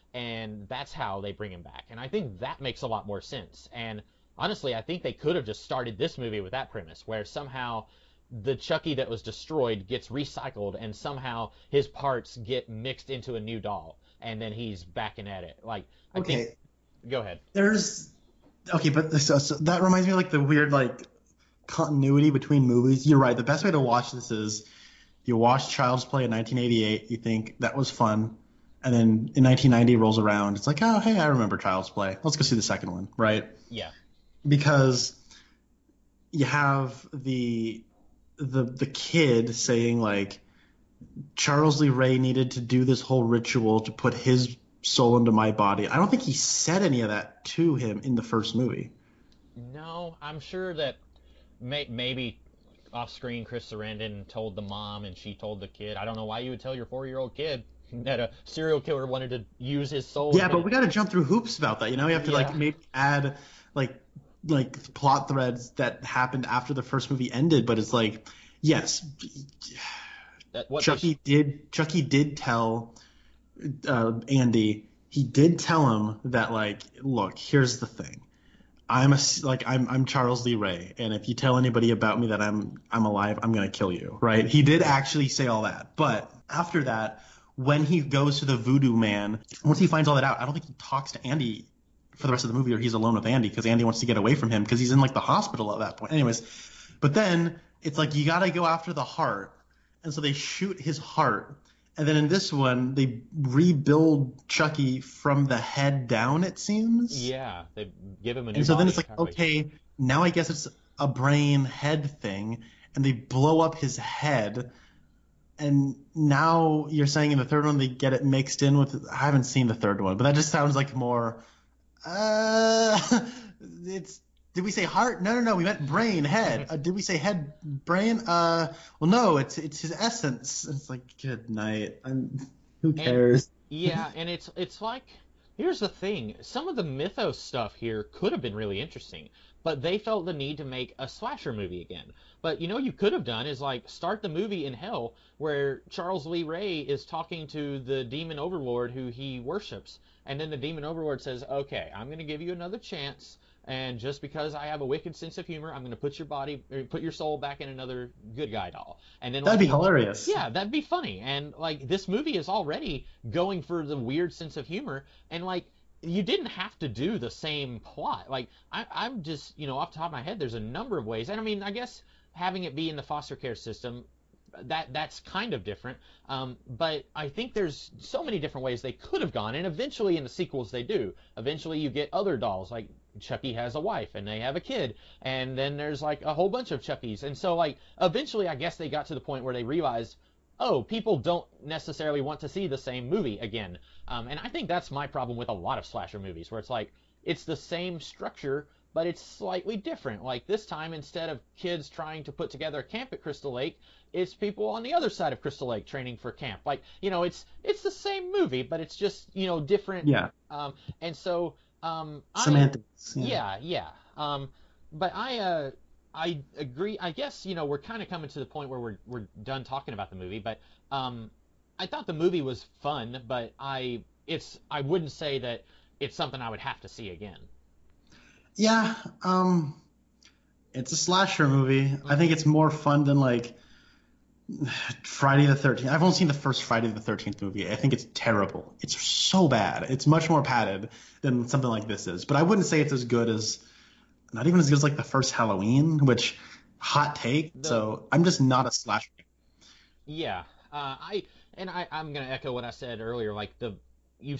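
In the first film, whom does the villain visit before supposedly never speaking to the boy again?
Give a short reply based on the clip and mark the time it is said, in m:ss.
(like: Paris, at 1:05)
the Voodoo Man, at 1:28.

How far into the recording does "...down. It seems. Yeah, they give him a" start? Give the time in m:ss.
1:46.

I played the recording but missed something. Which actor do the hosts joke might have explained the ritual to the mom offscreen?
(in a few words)
Chris Sarandon.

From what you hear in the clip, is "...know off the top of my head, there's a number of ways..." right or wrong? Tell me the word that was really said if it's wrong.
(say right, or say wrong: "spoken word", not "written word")
right.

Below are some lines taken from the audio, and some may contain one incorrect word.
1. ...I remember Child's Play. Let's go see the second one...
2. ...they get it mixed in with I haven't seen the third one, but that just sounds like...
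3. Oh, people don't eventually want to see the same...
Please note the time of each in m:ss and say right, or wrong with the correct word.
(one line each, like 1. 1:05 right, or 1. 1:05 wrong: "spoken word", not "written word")
1. 0:31 right
2. 1:57 right
3. 3:10 wrong: "necessarily", not "eventually".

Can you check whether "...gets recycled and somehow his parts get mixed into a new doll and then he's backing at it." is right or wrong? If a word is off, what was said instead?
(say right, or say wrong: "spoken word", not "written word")
right.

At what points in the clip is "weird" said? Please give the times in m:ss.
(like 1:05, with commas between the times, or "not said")
0:20, 2:43.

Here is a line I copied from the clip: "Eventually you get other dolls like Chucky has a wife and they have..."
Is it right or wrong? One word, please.
right.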